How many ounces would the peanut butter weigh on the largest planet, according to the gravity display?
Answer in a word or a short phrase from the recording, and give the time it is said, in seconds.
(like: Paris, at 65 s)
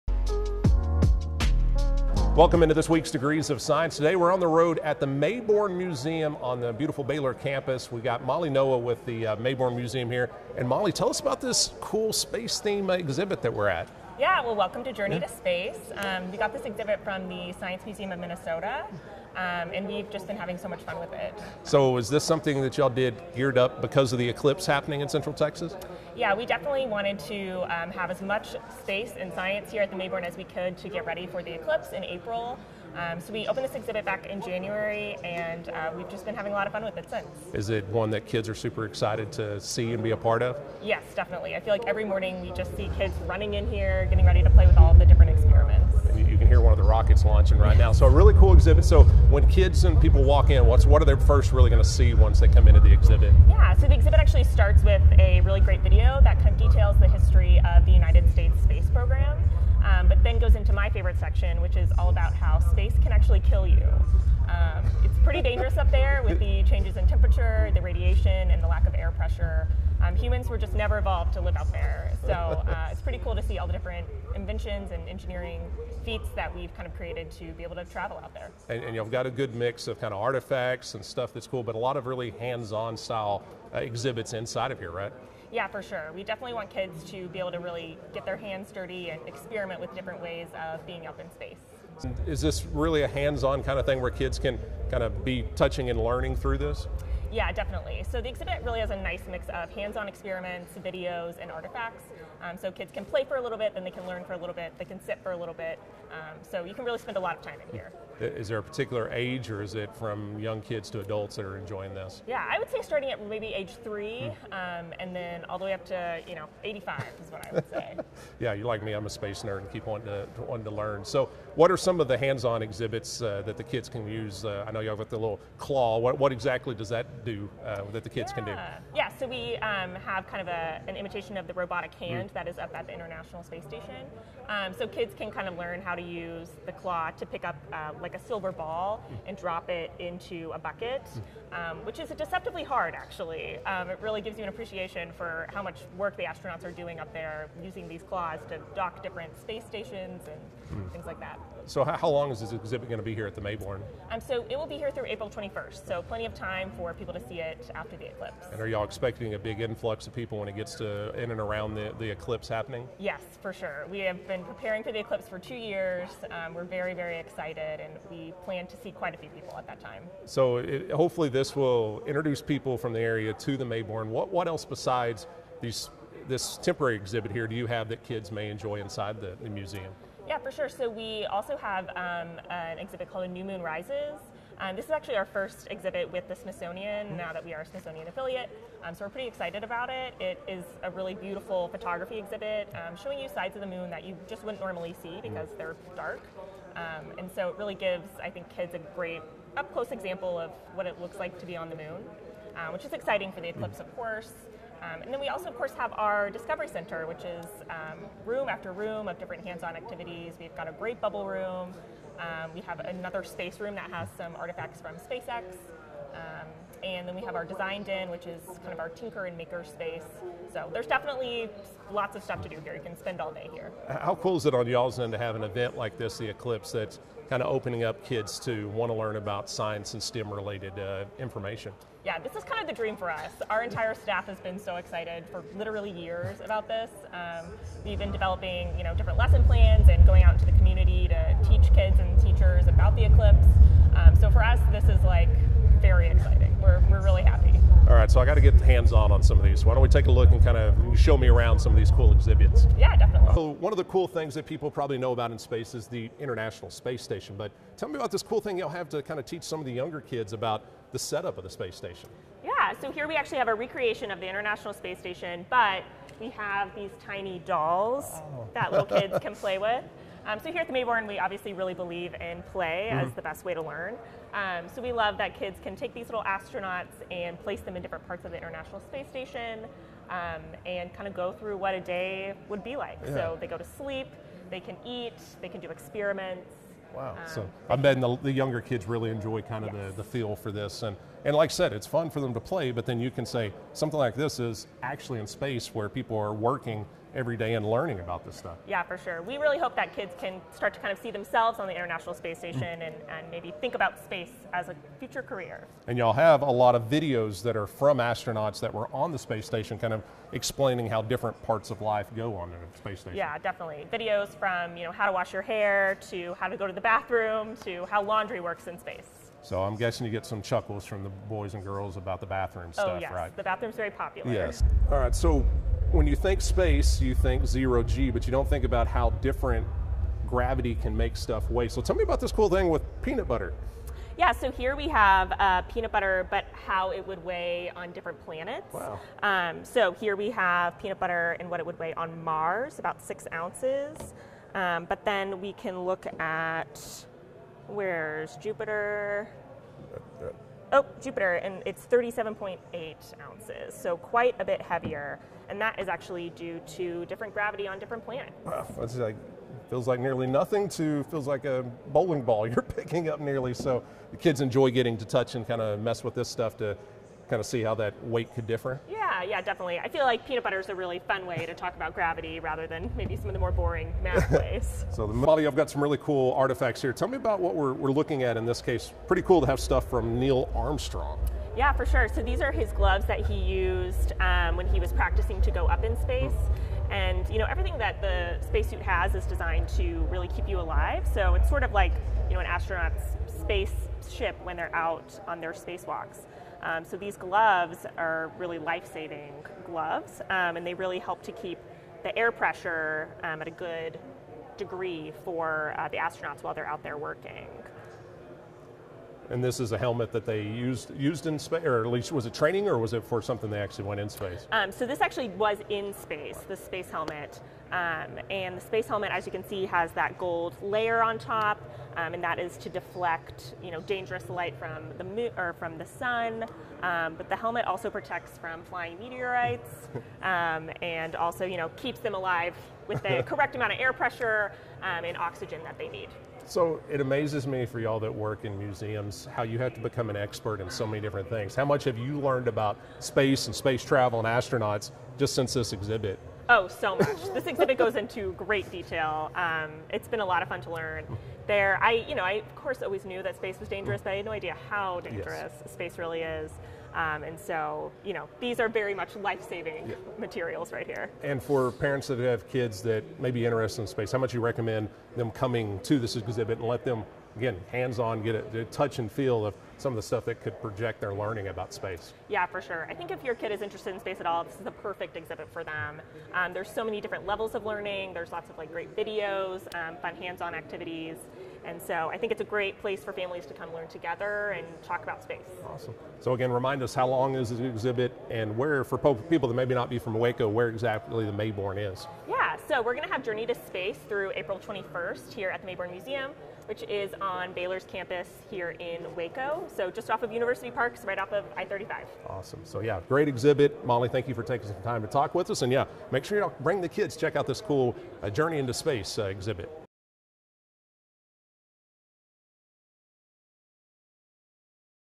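37.8 ounces, at 351 s.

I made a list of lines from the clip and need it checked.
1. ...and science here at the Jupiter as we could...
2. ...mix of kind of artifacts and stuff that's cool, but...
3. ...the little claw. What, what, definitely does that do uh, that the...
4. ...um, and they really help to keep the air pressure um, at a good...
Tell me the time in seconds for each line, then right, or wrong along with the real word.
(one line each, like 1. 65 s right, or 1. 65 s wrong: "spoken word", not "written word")
1. 29 s wrong: "Mayborn", not "Jupiter"
2. 79 s right
3. 125 s wrong: "exactly", not "definitely"
4. 400 s right.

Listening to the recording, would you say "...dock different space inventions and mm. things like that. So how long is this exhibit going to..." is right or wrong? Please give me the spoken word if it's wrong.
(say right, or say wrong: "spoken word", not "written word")
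wrong: "stations", not "inventions".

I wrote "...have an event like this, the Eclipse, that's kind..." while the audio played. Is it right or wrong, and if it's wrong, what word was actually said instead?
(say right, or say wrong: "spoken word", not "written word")
right.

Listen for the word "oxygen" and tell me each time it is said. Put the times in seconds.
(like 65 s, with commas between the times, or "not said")
435 s.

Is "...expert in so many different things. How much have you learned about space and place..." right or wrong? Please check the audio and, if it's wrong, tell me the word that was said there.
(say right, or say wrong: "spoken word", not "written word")
wrong: "space", not "place".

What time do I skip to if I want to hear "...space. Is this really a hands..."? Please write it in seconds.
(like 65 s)
91 s.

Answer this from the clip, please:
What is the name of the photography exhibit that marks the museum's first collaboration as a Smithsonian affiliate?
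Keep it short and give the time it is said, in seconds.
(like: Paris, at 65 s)
New Moon Rises, at 183 s.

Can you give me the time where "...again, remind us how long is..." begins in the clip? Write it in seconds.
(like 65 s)
486 s.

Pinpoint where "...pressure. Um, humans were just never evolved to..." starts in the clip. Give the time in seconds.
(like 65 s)
69 s.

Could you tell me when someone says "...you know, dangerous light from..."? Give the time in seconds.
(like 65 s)
423 s.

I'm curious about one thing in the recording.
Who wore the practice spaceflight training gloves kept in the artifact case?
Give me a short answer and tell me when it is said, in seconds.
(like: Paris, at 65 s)
Neil Armstrong, at 380 s.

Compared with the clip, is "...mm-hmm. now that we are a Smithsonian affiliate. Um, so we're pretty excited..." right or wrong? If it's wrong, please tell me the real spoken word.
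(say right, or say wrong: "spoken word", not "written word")
right.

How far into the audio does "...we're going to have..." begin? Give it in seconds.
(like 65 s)
492 s.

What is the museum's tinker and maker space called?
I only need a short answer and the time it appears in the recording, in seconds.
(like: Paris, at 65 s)
Design den, at 217 s.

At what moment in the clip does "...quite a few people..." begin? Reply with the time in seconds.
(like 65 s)
168 s.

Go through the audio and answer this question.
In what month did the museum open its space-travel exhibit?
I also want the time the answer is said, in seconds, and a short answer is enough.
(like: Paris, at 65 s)
January, at 34 s.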